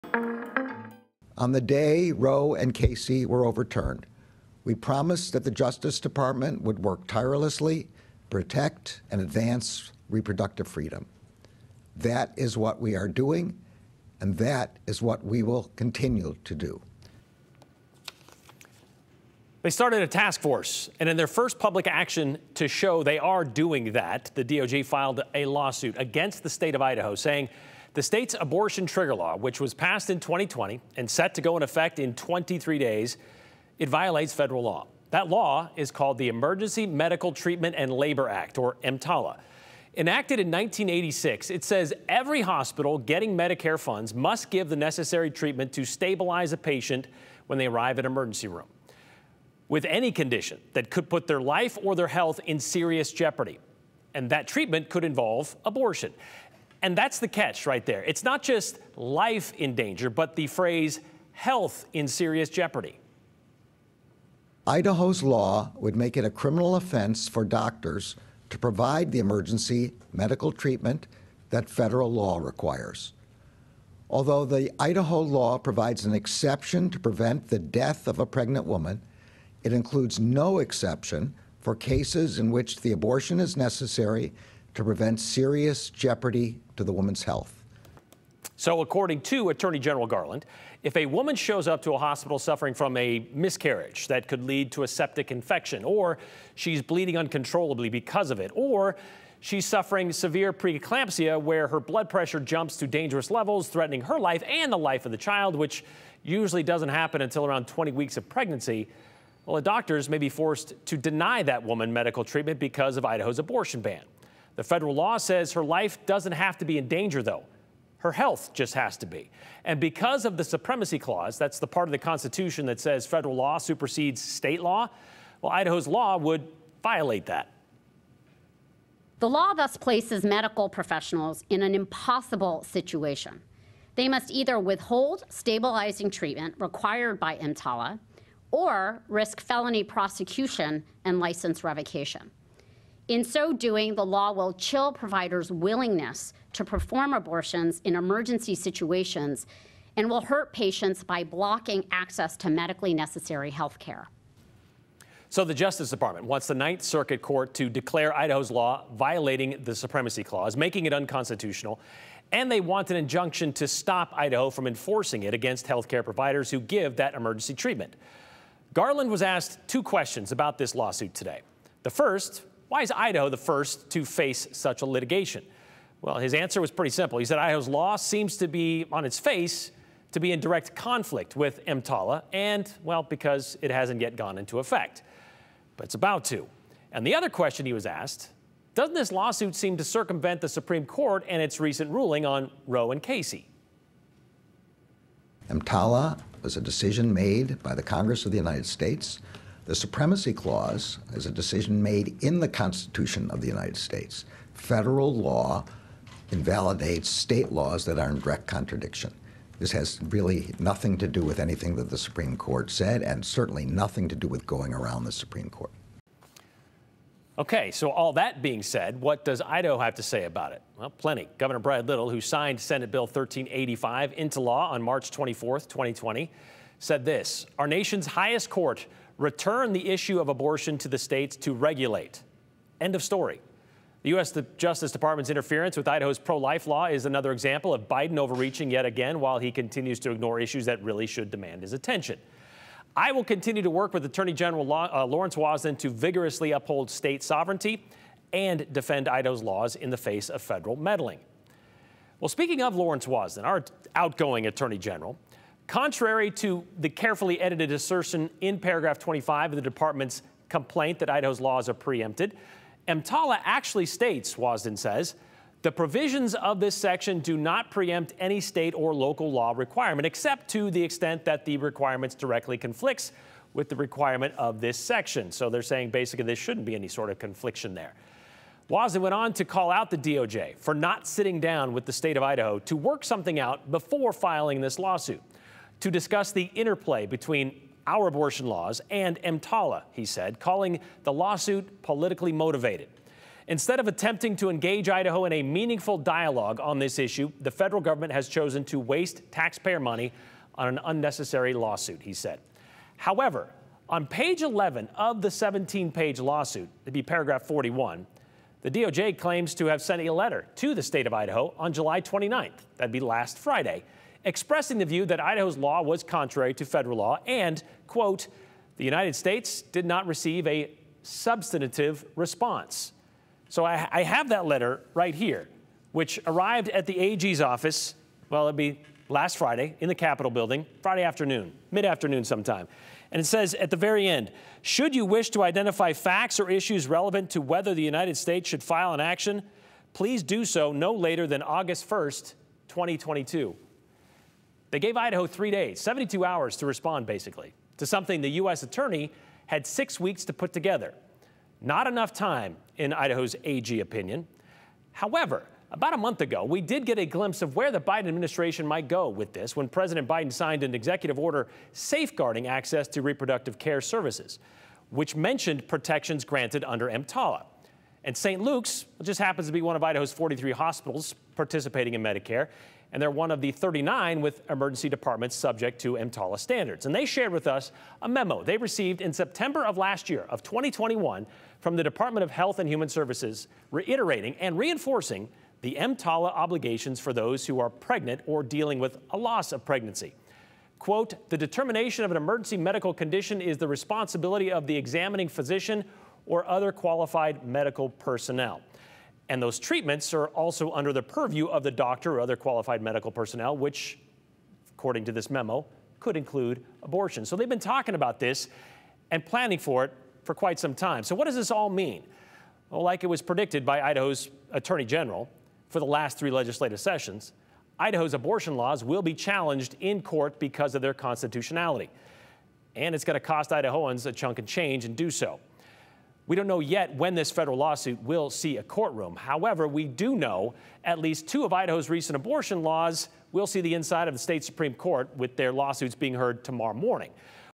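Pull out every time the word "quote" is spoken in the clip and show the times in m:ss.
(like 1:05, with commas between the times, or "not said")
5:17, 6:30.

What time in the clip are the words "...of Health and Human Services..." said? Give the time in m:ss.
6:22.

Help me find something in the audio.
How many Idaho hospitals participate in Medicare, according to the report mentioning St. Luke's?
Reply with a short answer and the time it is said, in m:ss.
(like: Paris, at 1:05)
43, at 6:10.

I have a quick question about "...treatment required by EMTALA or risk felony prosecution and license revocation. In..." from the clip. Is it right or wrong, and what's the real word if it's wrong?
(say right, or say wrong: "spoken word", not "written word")
right.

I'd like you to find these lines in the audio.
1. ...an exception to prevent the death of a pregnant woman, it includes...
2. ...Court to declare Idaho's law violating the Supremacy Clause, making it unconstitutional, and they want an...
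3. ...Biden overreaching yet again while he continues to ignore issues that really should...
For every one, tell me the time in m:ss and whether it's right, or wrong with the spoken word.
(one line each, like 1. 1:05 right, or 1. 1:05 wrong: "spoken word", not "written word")
1. 1:16 right
2. 2:37 right
3. 3:57 right.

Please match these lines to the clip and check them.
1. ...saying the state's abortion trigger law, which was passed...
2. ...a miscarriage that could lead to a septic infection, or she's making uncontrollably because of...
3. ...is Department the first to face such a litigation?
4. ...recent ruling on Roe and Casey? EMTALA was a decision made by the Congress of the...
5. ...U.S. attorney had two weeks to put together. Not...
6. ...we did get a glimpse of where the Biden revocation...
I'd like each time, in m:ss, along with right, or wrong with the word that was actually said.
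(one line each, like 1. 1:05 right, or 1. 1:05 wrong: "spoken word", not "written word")
1. 0:27 right
2. 1:32 wrong: "bleeding", not "making"
3. 2:52 wrong: "Idaho", not "Department"
4. 3:11 right
5. 5:48 wrong: "six", not "two"
6. 5:56 wrong: "administration", not "revocation".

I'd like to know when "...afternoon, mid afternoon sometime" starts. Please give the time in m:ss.
5:31.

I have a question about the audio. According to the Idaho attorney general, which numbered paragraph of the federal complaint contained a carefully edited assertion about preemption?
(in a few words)
Paragraph 25.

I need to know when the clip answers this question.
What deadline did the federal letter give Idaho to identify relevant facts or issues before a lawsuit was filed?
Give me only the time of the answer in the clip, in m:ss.
5:41.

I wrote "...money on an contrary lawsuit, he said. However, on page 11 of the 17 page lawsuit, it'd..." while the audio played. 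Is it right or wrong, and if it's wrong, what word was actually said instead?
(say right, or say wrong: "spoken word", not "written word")
wrong: "unnecessary", not "contrary".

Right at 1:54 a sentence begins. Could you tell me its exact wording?
The federal law says her life doesn't have to be in danger, though.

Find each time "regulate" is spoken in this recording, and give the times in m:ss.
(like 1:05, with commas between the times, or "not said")
3:51.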